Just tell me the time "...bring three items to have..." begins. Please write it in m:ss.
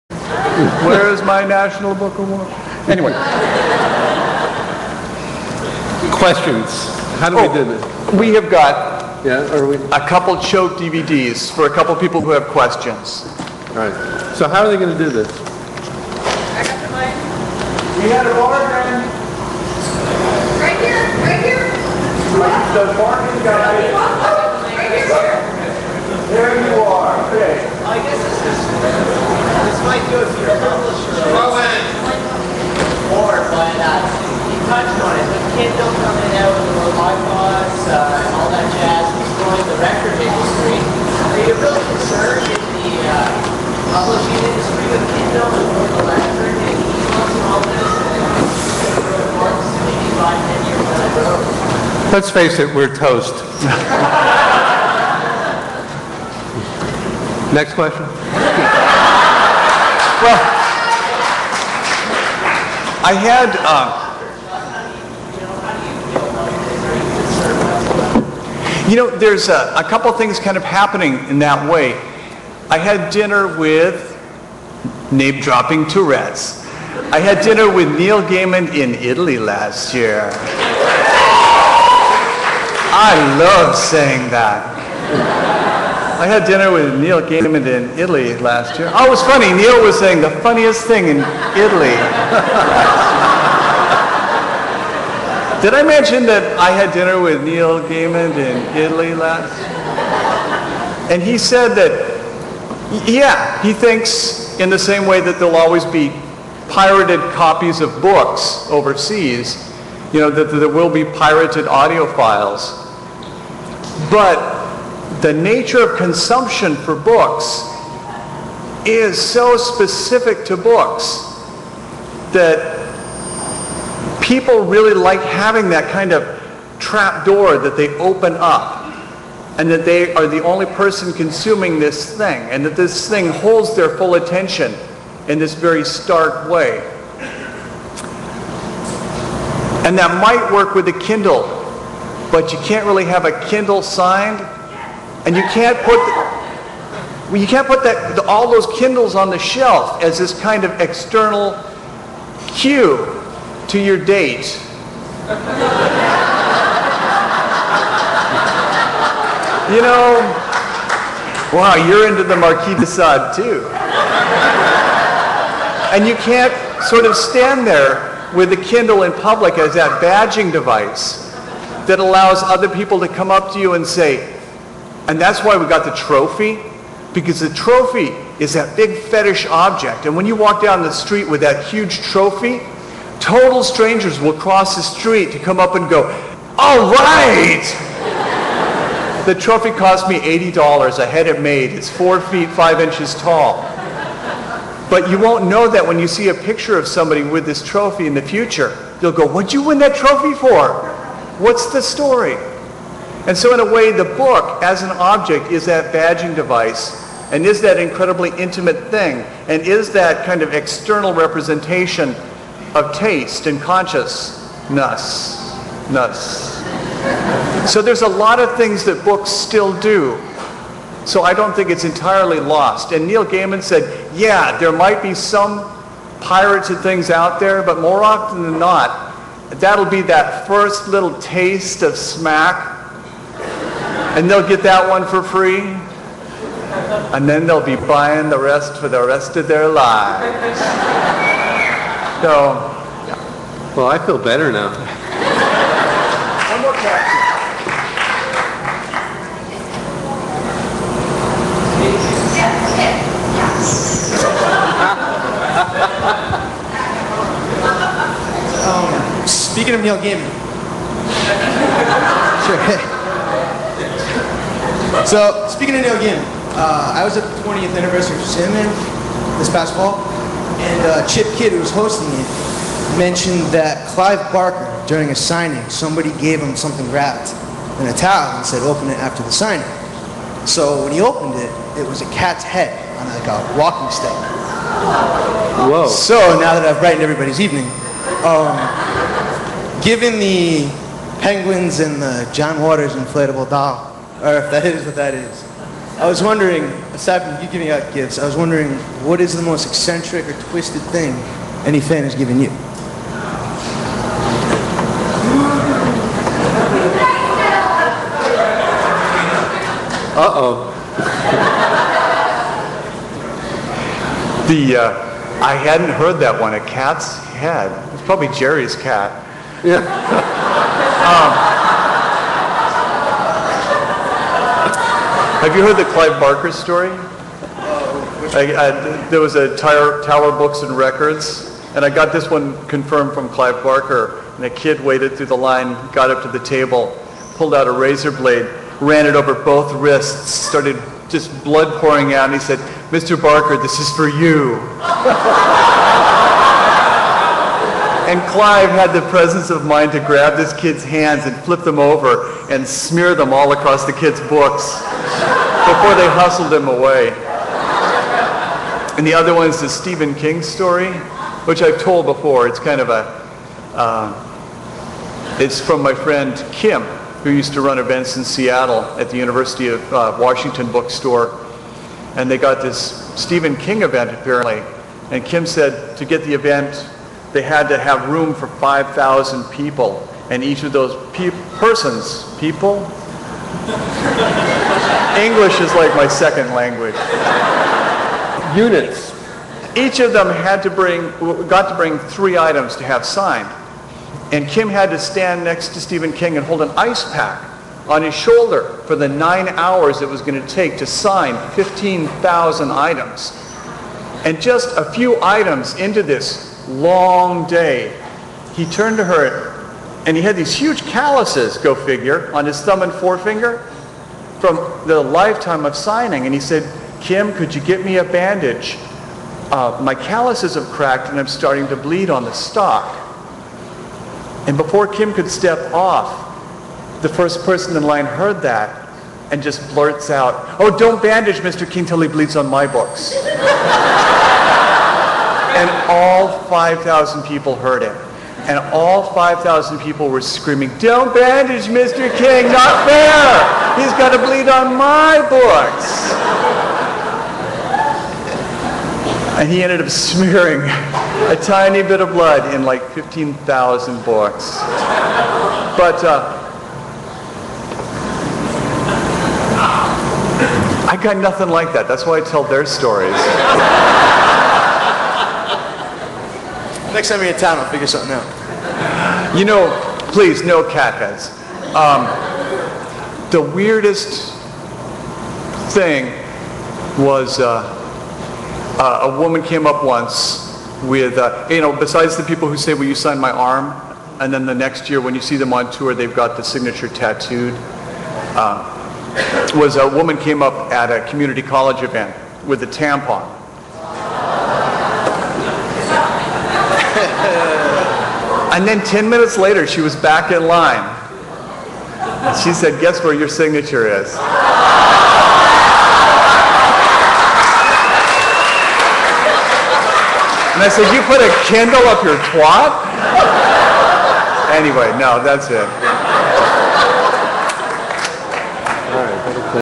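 6:31.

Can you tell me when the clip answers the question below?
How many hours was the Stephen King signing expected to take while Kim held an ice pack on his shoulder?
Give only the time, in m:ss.
6:39.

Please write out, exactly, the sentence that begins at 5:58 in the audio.
And the other one is the Stephen King story, which I've told before.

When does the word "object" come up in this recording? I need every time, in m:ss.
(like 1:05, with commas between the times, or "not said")
2:59, 3:24.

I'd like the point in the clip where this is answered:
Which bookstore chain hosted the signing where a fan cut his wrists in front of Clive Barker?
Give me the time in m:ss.
5:30.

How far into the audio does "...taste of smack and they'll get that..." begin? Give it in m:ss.
3:51.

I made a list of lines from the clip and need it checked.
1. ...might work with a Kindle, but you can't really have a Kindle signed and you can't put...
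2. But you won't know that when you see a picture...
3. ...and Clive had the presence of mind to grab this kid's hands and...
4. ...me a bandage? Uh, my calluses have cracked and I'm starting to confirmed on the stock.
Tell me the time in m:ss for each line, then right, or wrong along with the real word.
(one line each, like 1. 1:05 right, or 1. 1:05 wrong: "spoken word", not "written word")
1. 2:20 right
2. 3:14 right
3. 5:48 right
4. 6:57 wrong: "bleed", not "confirmed".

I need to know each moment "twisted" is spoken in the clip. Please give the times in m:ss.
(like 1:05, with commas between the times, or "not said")
5:00.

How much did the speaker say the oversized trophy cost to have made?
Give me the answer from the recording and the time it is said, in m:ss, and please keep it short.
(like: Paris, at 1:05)
$80, at 3:10.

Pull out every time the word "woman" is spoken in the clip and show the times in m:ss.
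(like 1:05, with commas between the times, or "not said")
7:59, 8:09.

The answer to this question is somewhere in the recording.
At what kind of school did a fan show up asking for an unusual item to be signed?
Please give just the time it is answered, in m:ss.
8:11.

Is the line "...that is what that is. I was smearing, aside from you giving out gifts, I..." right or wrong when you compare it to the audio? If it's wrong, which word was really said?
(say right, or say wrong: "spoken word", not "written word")
wrong: "wondering", not "smearing".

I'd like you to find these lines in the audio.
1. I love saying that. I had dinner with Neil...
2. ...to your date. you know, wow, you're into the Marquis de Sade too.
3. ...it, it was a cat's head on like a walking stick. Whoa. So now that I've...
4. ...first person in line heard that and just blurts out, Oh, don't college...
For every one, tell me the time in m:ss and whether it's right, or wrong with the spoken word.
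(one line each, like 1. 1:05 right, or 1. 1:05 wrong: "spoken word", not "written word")
1. 1:22 right
2. 2:33 right
3. 4:41 right
4. 7:07 wrong: "bandage", not "college".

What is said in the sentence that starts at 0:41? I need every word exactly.
Are you really concerned in the uh, publishing industry with Kindle and Electric and and all this?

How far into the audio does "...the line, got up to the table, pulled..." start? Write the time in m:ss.
5:35.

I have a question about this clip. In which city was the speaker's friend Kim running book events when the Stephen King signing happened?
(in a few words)
Seattle.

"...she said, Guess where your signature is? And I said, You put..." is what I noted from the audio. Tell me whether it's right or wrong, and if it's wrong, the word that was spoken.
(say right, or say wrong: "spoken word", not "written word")
right.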